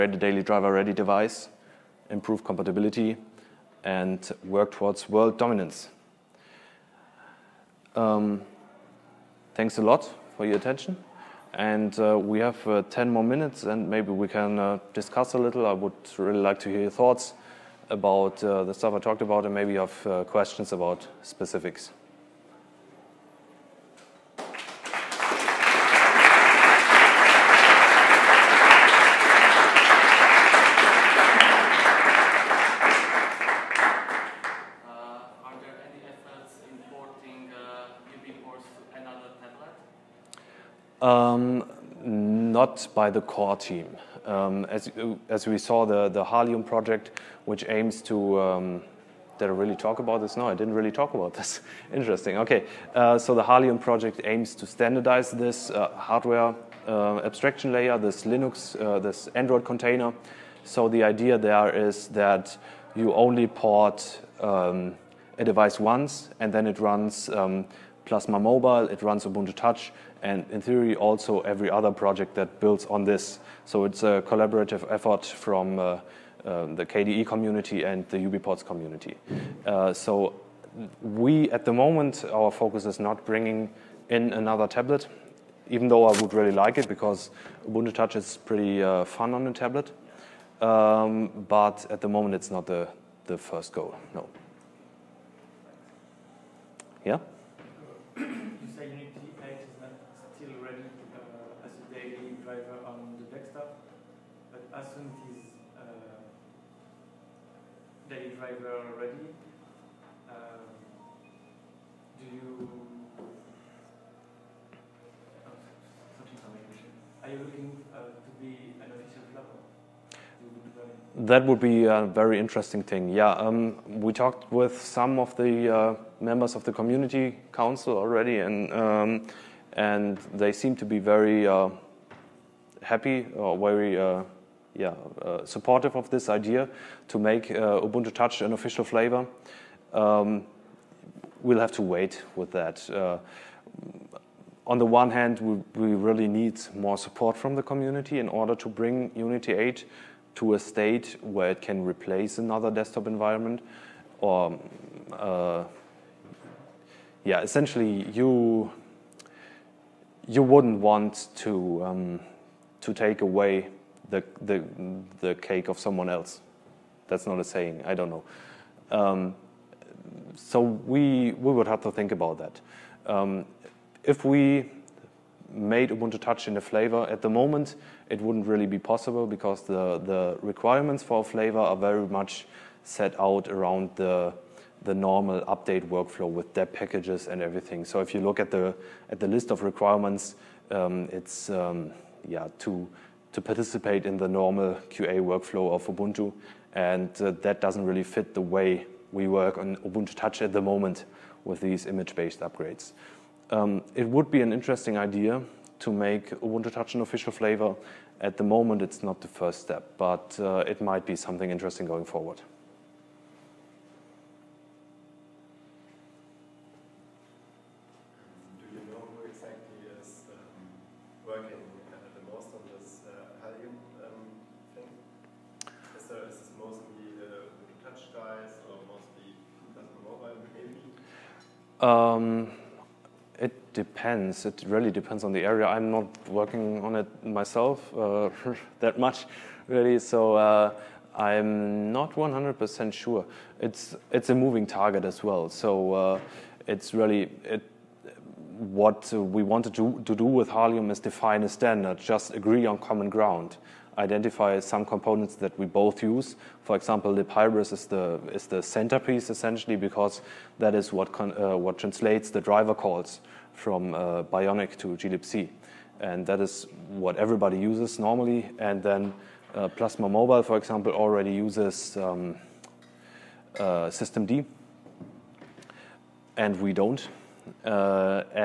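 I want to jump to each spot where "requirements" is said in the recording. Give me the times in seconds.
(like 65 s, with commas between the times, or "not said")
180 s, 189 s.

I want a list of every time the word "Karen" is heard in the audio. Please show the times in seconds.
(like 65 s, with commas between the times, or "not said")
not said.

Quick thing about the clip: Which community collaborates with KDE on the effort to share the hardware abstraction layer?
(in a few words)
UBports.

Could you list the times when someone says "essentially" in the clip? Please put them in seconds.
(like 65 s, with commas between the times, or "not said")
157 s, 259 s.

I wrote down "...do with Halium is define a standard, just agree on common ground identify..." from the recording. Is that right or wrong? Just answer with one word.
right.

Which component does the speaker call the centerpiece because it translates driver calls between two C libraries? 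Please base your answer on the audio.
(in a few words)
libhybris.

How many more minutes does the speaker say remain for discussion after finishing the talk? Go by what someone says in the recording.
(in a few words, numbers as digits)
10.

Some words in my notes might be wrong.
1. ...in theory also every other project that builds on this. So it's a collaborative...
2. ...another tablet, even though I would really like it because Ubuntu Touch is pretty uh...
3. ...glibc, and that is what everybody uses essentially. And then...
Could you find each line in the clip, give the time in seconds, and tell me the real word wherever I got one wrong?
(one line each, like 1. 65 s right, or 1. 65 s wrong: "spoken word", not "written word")
1. 70 s right
2. 84 s right
3. 264 s wrong: "normally", not "essentially".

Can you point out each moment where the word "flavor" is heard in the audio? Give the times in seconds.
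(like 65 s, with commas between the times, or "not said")
138 s, 176 s, 181 s, 207 s.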